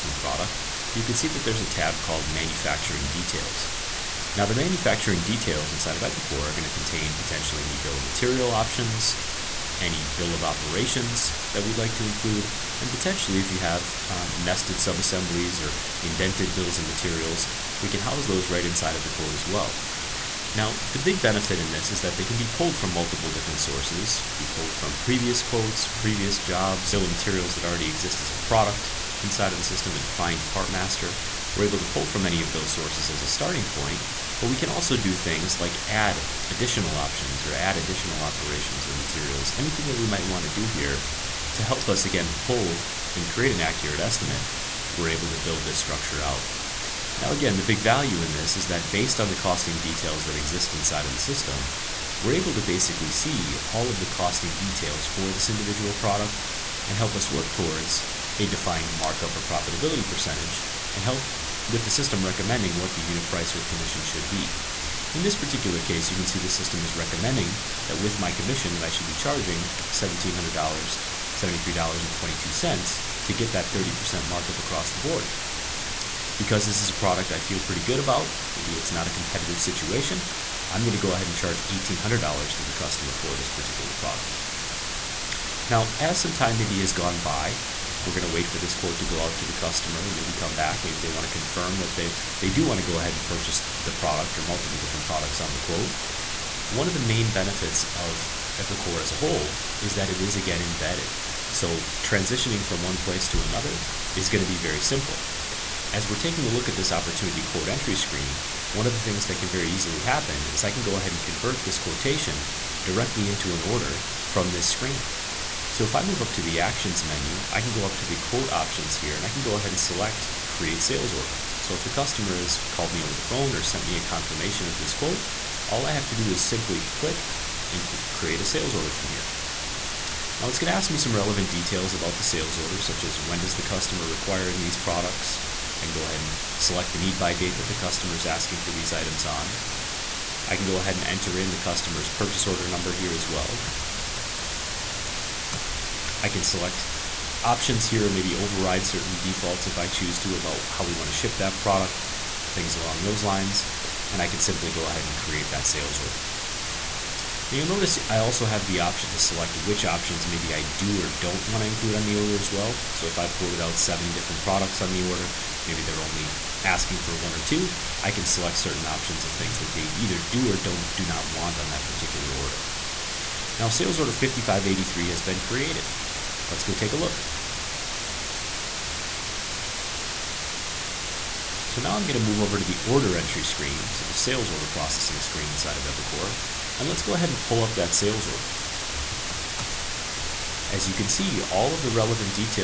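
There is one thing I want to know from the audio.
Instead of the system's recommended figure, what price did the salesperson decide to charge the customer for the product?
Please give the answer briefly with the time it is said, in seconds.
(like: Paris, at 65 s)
$1,800, at 81 s.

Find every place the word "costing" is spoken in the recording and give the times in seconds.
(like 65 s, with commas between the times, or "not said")
49 s, 54 s.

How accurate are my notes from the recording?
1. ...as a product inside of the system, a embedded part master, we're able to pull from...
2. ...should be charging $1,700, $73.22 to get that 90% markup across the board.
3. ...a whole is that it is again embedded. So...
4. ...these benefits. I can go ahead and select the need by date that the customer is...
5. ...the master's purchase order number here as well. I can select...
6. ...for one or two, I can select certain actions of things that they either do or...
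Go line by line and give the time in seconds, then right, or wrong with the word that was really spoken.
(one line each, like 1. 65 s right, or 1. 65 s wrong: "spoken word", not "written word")
1. 28 s wrong: "defined", not "embedded"
2. 68 s wrong: "30", not "90"
3. 99 s right
4. 134 s wrong: "products", not "benefits"
5. 141 s wrong: "customer", not "master"
6. 166 s wrong: "options", not "actions".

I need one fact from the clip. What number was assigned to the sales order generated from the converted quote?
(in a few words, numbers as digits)
5583.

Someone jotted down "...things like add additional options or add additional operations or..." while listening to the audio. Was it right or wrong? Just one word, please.
right.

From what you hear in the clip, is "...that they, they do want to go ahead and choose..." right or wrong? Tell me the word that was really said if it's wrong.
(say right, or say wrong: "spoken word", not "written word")
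wrong: "purchase", not "choose".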